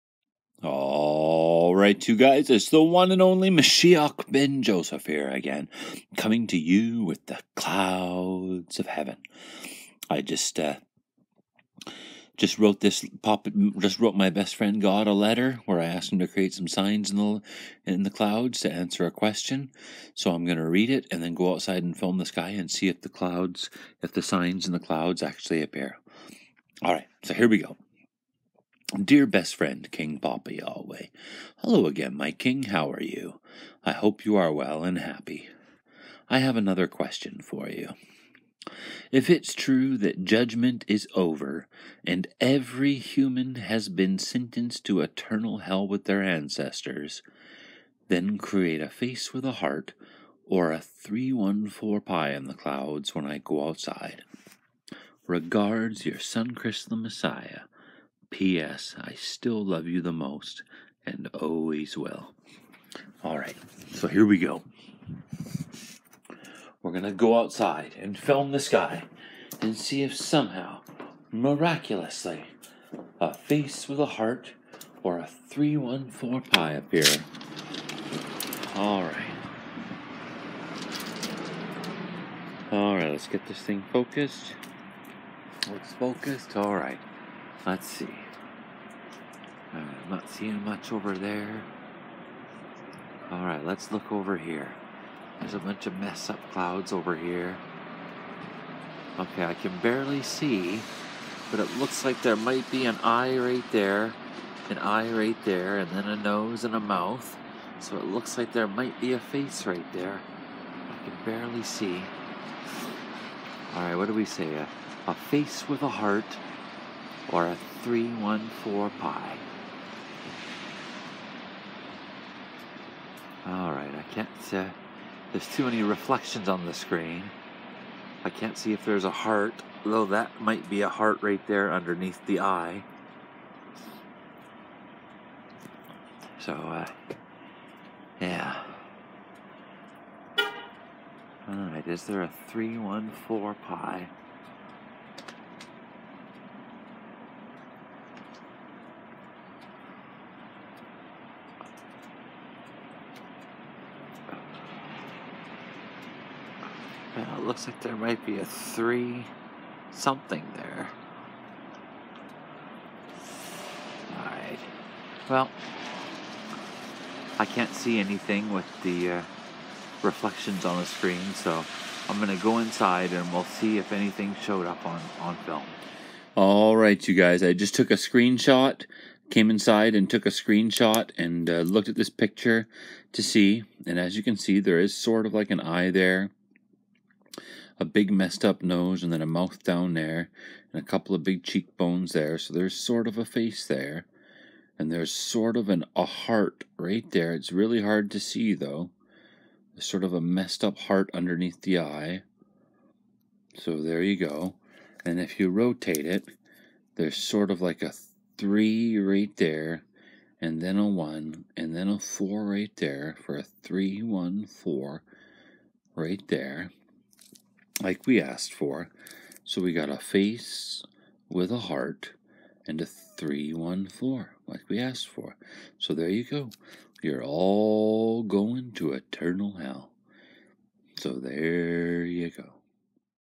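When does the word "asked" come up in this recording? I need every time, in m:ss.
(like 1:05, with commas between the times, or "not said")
0:15, 3:38, 3:44.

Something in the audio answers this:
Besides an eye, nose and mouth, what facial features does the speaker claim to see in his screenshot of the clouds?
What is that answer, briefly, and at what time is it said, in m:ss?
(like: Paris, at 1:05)
cheekbones, at 3:11.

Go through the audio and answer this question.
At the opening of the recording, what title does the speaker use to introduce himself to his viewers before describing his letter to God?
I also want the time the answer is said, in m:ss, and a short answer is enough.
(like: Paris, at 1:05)
Mashiach ben Joseph, at 0:03.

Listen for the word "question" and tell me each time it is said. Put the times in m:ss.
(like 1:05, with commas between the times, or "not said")
0:19, 0:36.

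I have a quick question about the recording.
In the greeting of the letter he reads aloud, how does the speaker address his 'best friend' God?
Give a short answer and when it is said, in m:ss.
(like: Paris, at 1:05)
King Papa Yahweh, at 0:29.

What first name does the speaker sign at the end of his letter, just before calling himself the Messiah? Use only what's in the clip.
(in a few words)
Chris.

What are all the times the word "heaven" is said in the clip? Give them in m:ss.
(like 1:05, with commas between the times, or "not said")
0:08.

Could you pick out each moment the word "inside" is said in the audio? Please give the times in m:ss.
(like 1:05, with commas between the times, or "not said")
2:52, 2:59.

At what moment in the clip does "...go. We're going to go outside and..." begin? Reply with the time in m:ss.
1:04.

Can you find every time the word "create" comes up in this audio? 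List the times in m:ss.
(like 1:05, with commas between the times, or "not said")
0:16, 0:48.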